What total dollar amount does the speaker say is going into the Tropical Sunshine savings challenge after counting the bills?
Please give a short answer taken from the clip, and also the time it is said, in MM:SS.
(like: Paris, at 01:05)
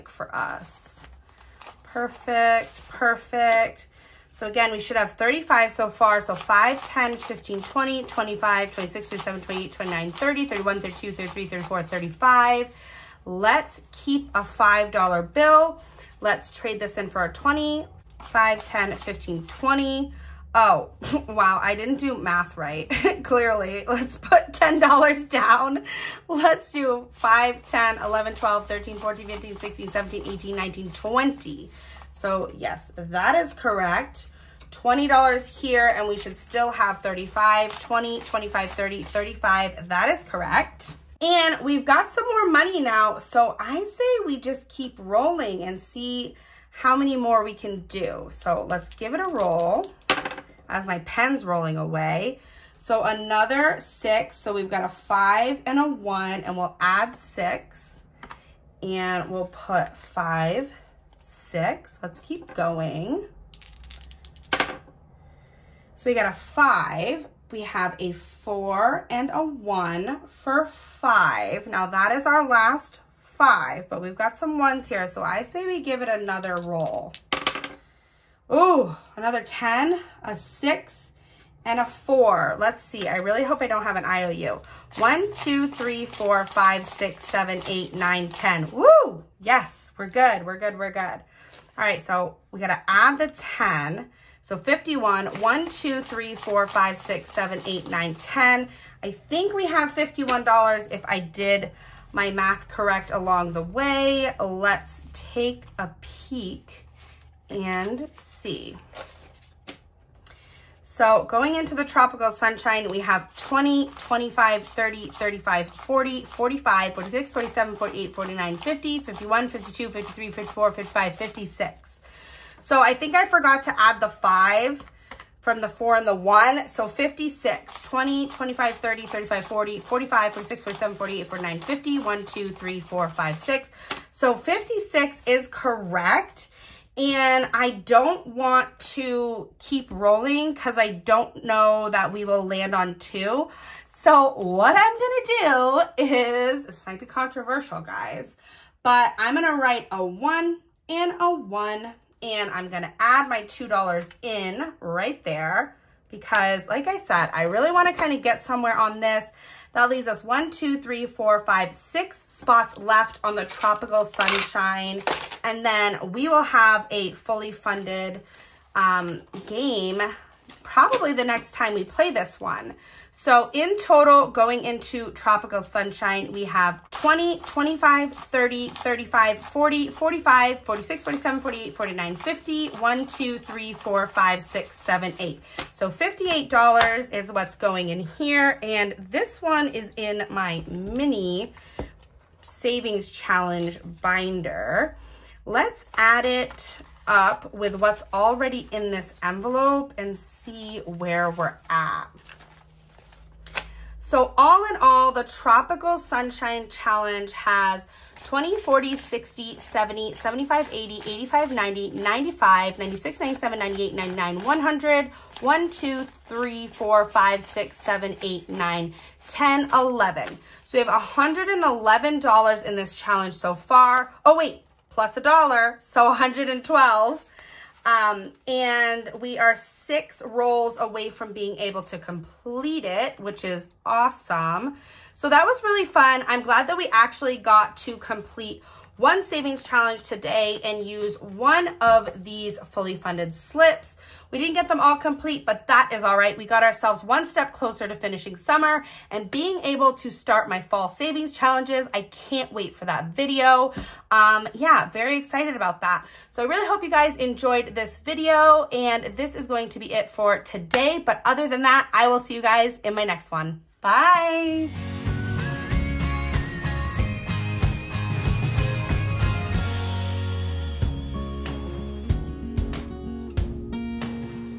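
$58, at 03:05.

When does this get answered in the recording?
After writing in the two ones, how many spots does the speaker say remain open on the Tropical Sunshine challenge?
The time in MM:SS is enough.
02:41.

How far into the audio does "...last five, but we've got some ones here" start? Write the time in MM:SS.
01:12.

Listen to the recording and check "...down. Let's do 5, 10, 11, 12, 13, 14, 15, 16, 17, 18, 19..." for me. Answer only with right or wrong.
right.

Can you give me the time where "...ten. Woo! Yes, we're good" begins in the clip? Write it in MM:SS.
01:28.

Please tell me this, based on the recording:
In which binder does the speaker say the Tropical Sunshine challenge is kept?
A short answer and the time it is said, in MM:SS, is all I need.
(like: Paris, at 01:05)
mini savings challenge binder, at 03:10.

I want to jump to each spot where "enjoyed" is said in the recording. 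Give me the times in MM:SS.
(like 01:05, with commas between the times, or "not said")
04:17.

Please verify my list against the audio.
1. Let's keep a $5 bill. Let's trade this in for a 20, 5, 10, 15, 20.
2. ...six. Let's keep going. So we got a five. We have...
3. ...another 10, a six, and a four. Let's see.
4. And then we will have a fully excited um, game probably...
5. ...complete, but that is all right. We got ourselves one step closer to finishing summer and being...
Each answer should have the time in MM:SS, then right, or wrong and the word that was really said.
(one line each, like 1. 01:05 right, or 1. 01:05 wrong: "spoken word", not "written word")
1. 00:13 right
2. 01:01 right
3. 01:19 right
4. 02:45 wrong: "funded", not "excited"
5. 04:04 right.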